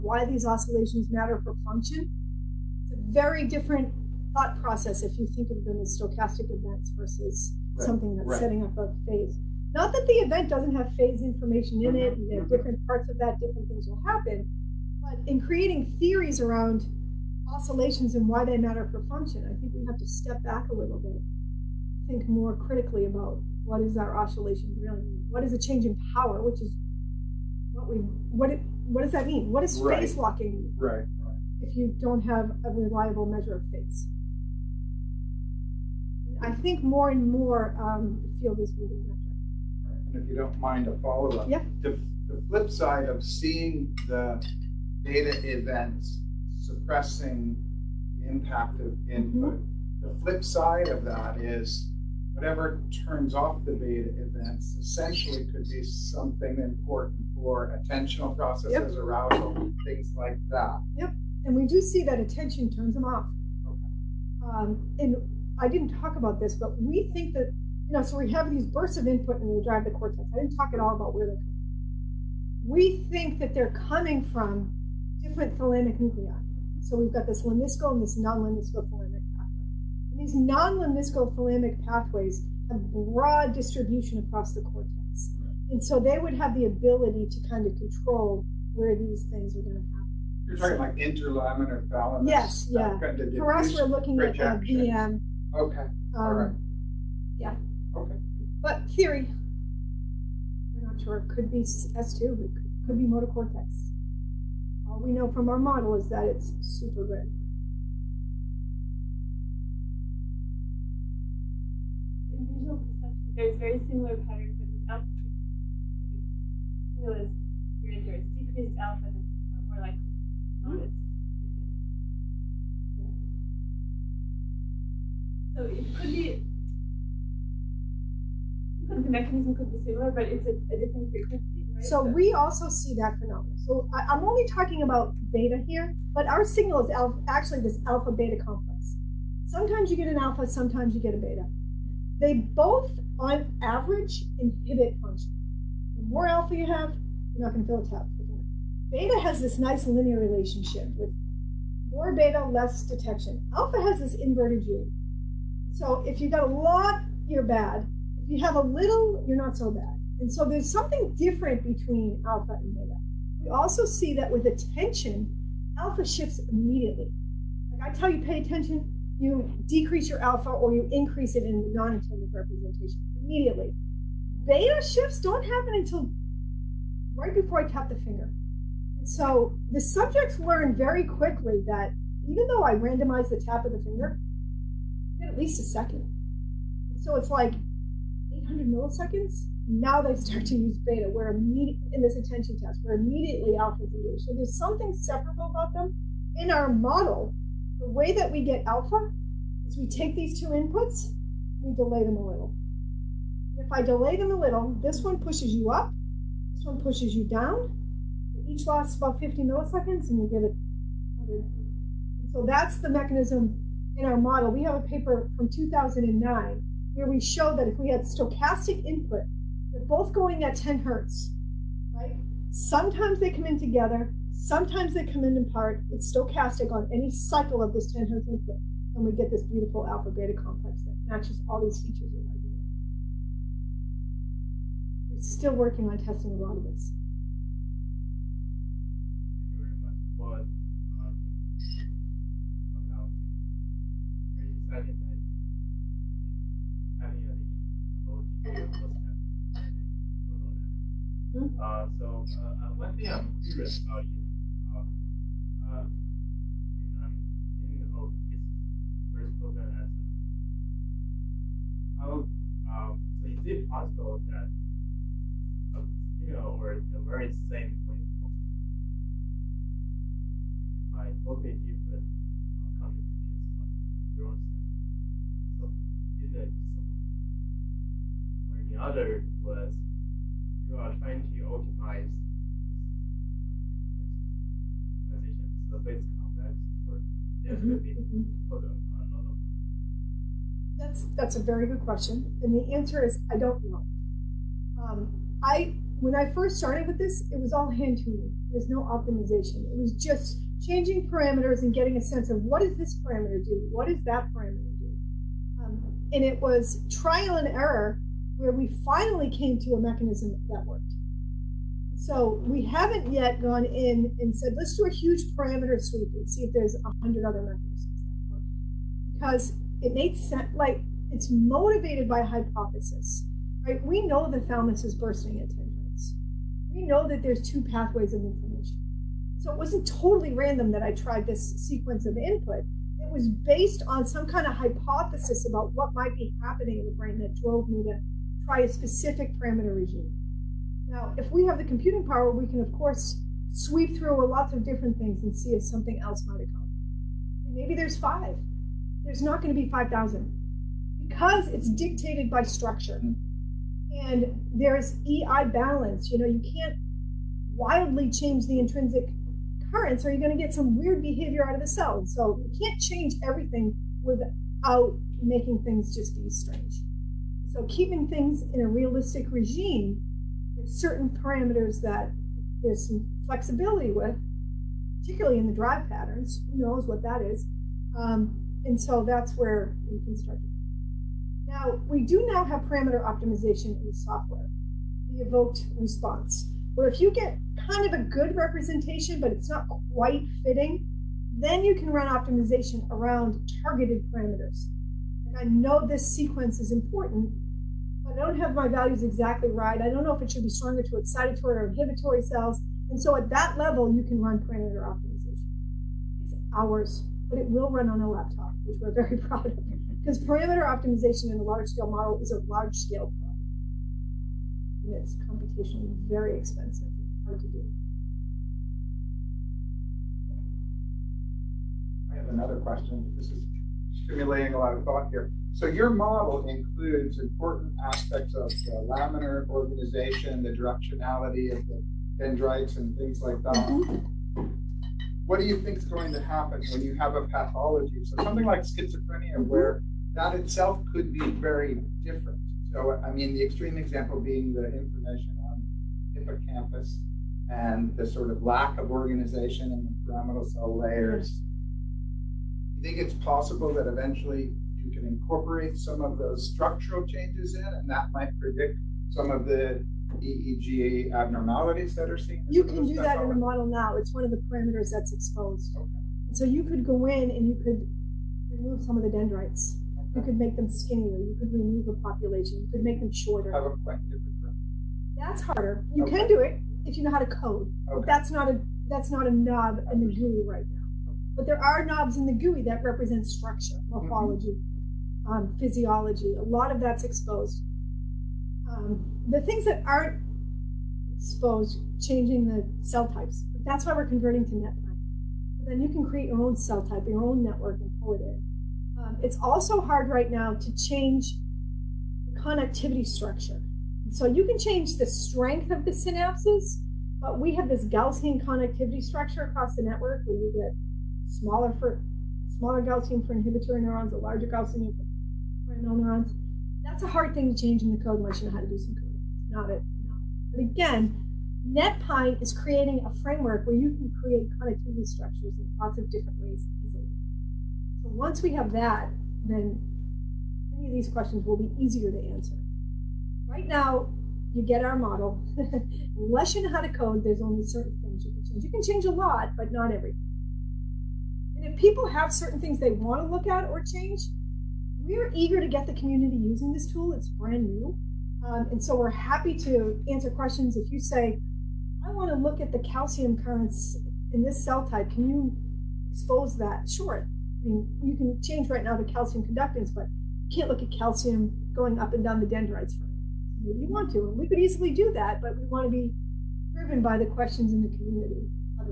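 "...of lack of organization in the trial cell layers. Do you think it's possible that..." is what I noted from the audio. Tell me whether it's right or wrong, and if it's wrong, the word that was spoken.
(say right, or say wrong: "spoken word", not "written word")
wrong: "pyramidal", not "trial".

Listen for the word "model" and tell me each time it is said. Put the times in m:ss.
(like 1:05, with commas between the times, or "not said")
1:45, 3:16, 3:34, 6:51, 7:05, 7:43, 8:54.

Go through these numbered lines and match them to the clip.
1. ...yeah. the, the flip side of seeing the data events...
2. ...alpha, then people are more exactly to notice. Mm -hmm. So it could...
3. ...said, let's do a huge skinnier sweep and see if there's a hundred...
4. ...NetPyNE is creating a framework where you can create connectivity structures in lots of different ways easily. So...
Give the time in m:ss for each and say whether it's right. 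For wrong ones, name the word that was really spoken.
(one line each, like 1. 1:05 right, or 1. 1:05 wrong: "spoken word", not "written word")
1. 0:41 right
2. 1:58 wrong: "likely", not "exactly"
3. 5:14 wrong: "parameter", not "skinnier"
4. 8:41 right.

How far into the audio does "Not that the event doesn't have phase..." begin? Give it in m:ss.
0:09.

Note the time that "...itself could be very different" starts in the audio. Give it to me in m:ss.
7:20.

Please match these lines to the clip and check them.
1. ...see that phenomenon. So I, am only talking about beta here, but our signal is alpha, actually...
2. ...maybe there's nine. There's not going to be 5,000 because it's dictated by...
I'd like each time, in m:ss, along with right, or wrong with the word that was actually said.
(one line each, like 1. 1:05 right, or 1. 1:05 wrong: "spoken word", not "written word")
1. 2:12 right
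2. 5:47 wrong: "five", not "nine".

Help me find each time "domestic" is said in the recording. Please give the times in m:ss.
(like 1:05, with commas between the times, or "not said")
not said.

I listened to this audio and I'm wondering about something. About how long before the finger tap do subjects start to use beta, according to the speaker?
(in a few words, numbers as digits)
800 milliseconds.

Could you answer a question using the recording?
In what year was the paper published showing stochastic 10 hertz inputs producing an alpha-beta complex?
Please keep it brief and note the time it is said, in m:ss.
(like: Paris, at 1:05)
2009, at 3:35.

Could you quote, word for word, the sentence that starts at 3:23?
And if I delay them a little, this one pushes you up, this one pushes you down.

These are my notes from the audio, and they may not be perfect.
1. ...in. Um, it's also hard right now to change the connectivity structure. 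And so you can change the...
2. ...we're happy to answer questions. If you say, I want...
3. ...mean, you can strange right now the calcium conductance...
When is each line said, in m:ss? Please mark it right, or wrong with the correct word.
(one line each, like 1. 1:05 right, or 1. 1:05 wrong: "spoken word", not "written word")
1. 8:18 right
2. 9:08 right
3. 9:17 wrong: "change", not "strange".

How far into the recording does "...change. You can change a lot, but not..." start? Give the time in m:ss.
8:58.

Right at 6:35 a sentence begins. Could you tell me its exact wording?
Like I know this sequence is important, I don't have my values exactly right.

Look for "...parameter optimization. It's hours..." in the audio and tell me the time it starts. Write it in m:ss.
6:44.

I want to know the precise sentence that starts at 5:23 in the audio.
We know the thalamus is bursting at 10 We know that there's two pathways of information.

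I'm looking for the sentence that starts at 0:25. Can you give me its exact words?
What is a change in power, which is what we what it what does that mean?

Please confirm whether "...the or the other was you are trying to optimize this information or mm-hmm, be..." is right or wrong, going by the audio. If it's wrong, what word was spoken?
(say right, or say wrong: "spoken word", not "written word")
wrong: "optimization", not "information".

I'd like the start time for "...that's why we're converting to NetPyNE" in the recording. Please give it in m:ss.
8:13.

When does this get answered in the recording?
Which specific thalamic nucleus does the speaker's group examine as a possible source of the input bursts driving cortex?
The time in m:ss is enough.
1:34.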